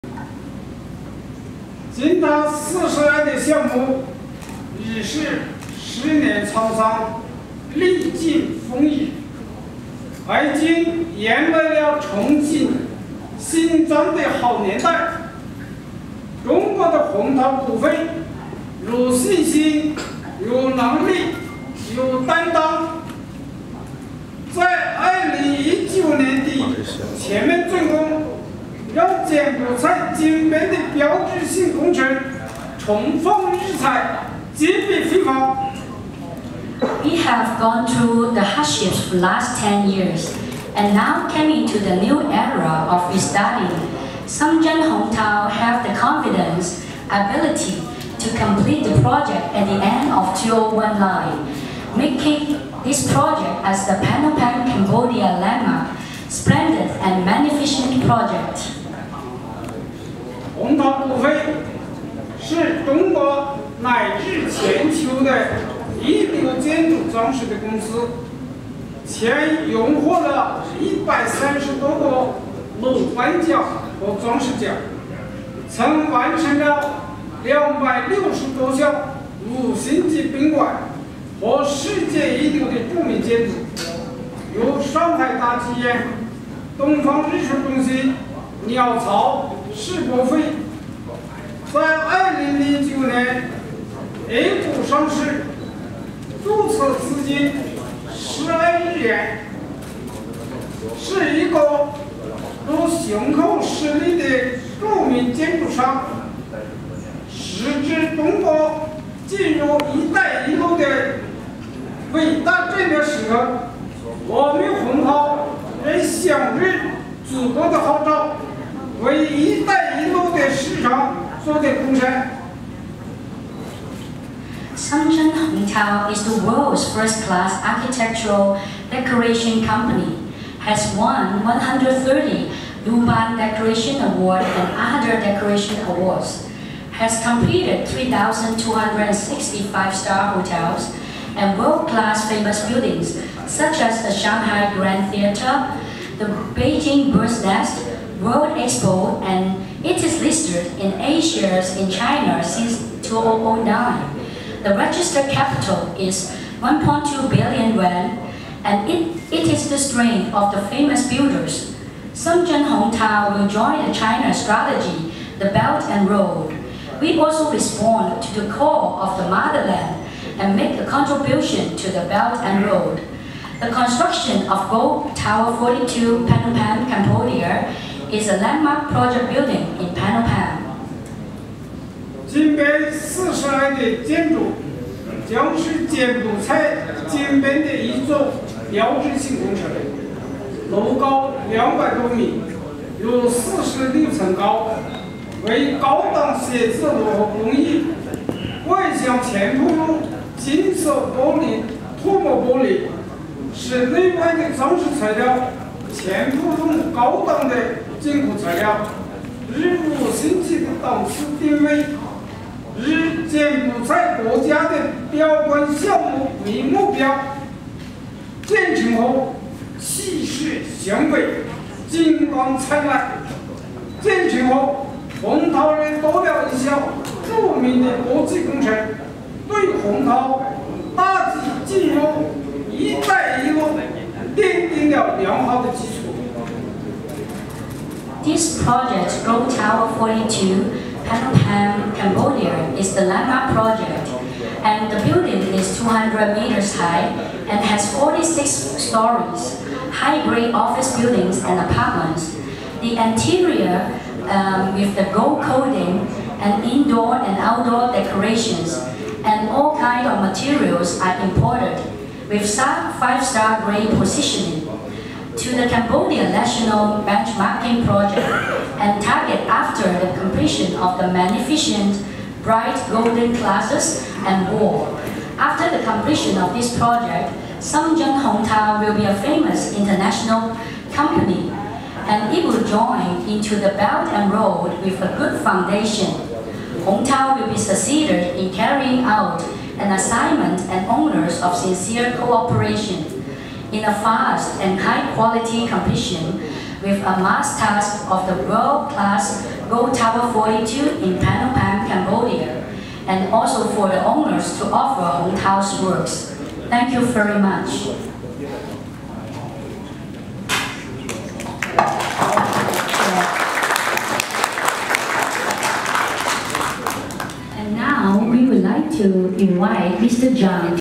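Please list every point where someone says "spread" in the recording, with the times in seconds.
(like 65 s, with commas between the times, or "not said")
not said.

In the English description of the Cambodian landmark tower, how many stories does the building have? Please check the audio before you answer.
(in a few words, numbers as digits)
46.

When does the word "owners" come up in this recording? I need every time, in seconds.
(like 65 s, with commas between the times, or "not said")
290 s, 304 s.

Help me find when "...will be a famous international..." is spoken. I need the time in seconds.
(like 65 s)
278 s.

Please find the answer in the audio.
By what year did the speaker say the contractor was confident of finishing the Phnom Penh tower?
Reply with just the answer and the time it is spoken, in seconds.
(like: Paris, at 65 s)
2019, at 49 s.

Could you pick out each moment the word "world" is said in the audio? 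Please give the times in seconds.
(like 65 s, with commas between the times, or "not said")
126 s, 141 s, 148 s, 298 s.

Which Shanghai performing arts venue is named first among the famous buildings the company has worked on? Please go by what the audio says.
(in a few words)
Shanghai Grand Theater.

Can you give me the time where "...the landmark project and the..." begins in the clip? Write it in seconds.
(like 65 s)
242 s.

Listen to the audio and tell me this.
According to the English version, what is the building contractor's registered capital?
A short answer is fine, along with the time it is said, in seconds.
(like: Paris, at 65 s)
1.2 billion yuan, at 156 s.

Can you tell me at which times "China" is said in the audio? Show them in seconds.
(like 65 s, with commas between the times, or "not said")
151 s, 163 s.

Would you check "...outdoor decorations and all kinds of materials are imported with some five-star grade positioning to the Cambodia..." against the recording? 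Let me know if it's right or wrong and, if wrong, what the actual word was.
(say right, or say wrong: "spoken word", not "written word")
right.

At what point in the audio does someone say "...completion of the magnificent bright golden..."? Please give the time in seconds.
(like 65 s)
270 s.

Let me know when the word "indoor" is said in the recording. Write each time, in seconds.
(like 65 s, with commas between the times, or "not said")
256 s.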